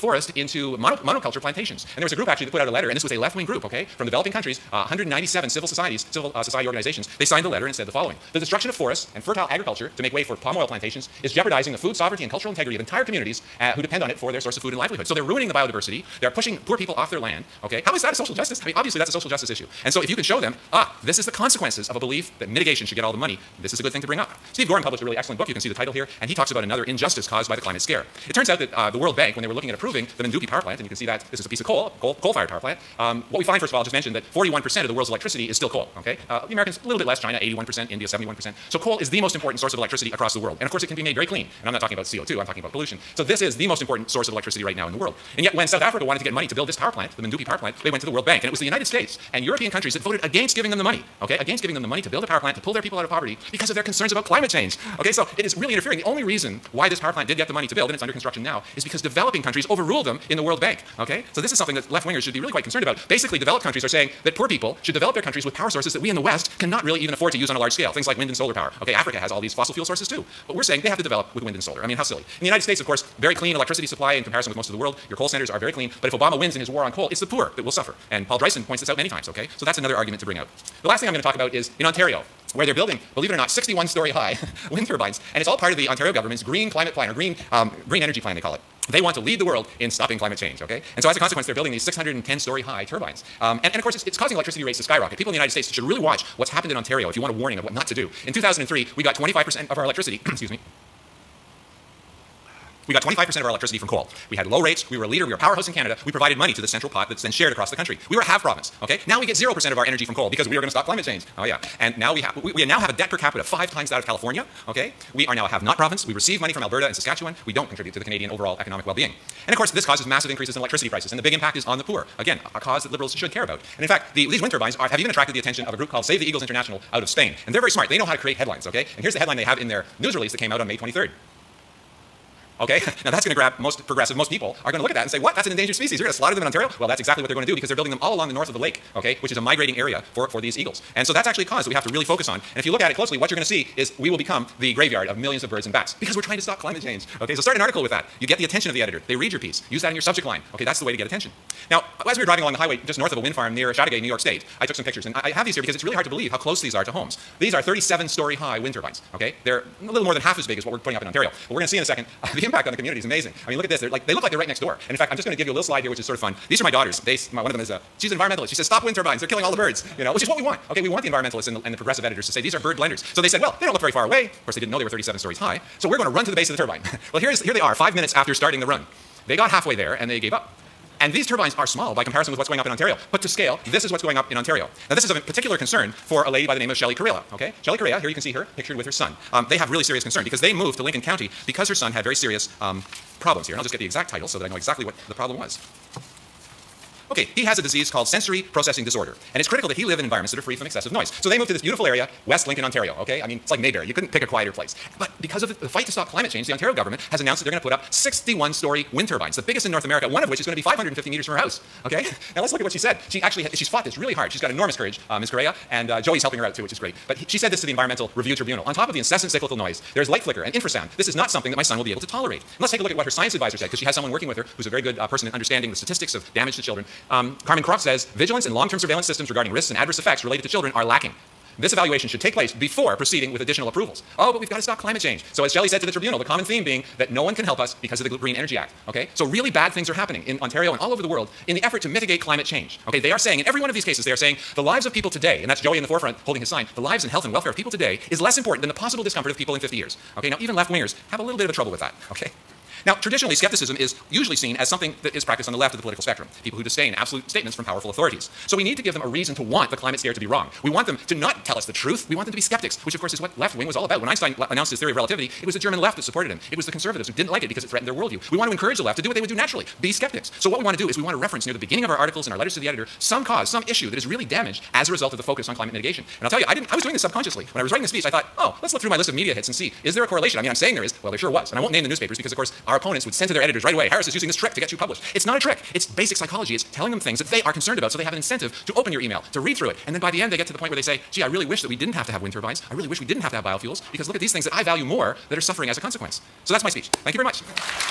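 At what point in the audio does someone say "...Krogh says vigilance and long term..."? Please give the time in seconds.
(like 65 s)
227 s.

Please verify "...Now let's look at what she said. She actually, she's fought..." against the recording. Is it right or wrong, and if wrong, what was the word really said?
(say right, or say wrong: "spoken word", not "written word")
right.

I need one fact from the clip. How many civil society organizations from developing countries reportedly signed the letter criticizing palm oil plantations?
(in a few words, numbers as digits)
197.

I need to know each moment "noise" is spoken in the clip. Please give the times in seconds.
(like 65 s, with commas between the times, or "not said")
200 s, 219 s.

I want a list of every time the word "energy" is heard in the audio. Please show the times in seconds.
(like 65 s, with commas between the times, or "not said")
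88 s, 109 s, 238 s.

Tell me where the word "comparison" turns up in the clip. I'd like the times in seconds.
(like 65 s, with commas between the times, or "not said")
74 s, 182 s.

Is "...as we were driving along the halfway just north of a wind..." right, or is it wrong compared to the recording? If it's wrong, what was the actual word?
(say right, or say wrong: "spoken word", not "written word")
wrong: "highway", not "halfway".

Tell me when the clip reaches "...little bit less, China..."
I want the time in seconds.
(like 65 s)
36 s.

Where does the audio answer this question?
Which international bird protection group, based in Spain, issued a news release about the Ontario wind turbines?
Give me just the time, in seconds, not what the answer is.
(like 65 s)
126 s.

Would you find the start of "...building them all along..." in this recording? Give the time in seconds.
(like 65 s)
137 s.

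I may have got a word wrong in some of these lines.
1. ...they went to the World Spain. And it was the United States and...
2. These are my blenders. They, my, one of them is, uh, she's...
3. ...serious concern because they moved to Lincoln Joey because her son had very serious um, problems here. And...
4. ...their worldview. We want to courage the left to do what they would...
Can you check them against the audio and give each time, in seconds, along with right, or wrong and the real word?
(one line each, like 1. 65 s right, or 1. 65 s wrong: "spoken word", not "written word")
1. 47 s wrong: "Bank", not "Spain"
2. 166 s wrong: "daughters", not "blenders"
3. 189 s wrong: "County", not "Joey"
4. 267 s wrong: "encourage", not "courage".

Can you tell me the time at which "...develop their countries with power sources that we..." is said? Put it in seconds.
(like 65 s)
64 s.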